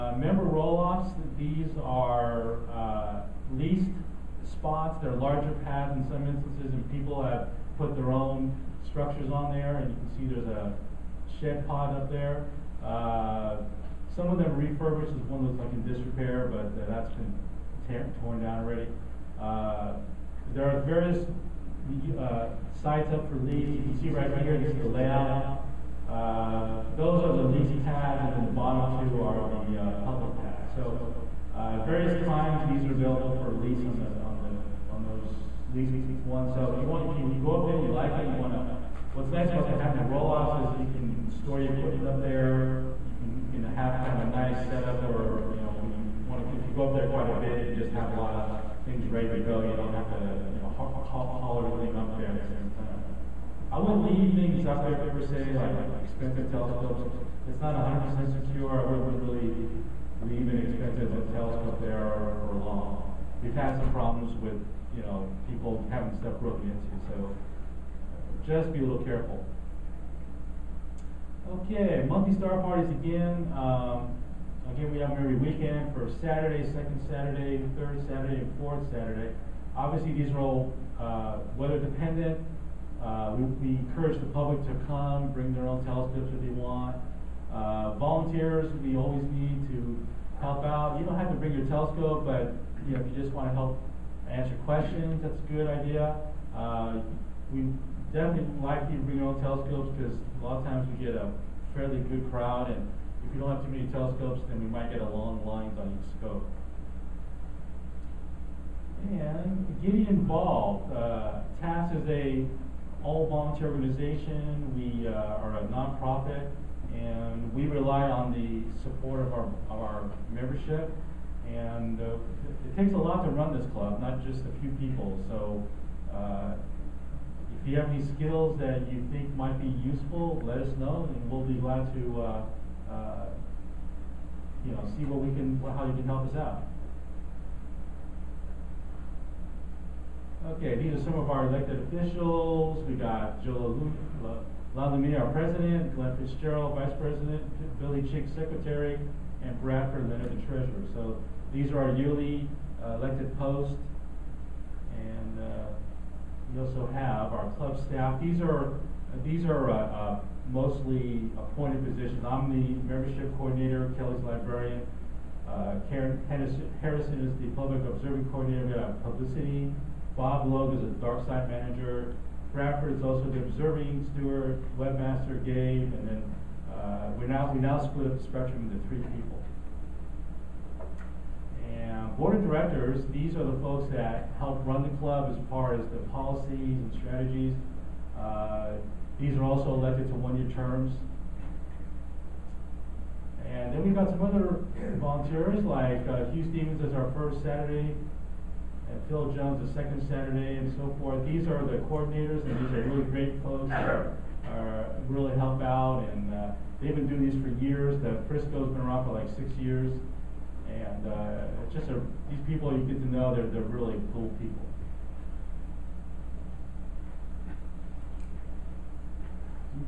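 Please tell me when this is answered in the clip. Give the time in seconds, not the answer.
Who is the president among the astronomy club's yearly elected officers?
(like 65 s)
143 s.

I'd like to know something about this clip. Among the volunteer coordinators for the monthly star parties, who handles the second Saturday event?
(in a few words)
Phil Jones.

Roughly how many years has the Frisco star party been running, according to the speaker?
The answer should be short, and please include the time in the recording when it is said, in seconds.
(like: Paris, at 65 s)
6 years, at 209 s.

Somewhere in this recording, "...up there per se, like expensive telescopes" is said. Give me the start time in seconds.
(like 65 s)
54 s.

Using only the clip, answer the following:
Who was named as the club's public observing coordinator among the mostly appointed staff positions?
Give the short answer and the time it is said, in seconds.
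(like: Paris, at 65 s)
Karen Harrison, at 165 s.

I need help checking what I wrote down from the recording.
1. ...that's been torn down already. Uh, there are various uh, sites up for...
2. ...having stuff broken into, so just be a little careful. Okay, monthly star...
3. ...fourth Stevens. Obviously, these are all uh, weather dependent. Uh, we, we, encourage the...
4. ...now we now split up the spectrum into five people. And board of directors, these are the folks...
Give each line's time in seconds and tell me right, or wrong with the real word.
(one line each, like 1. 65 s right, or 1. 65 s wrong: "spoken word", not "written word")
1. 16 s right
2. 65 s right
3. 78 s wrong: "Saturday", not "Stevens"
4. 177 s wrong: "three", not "five".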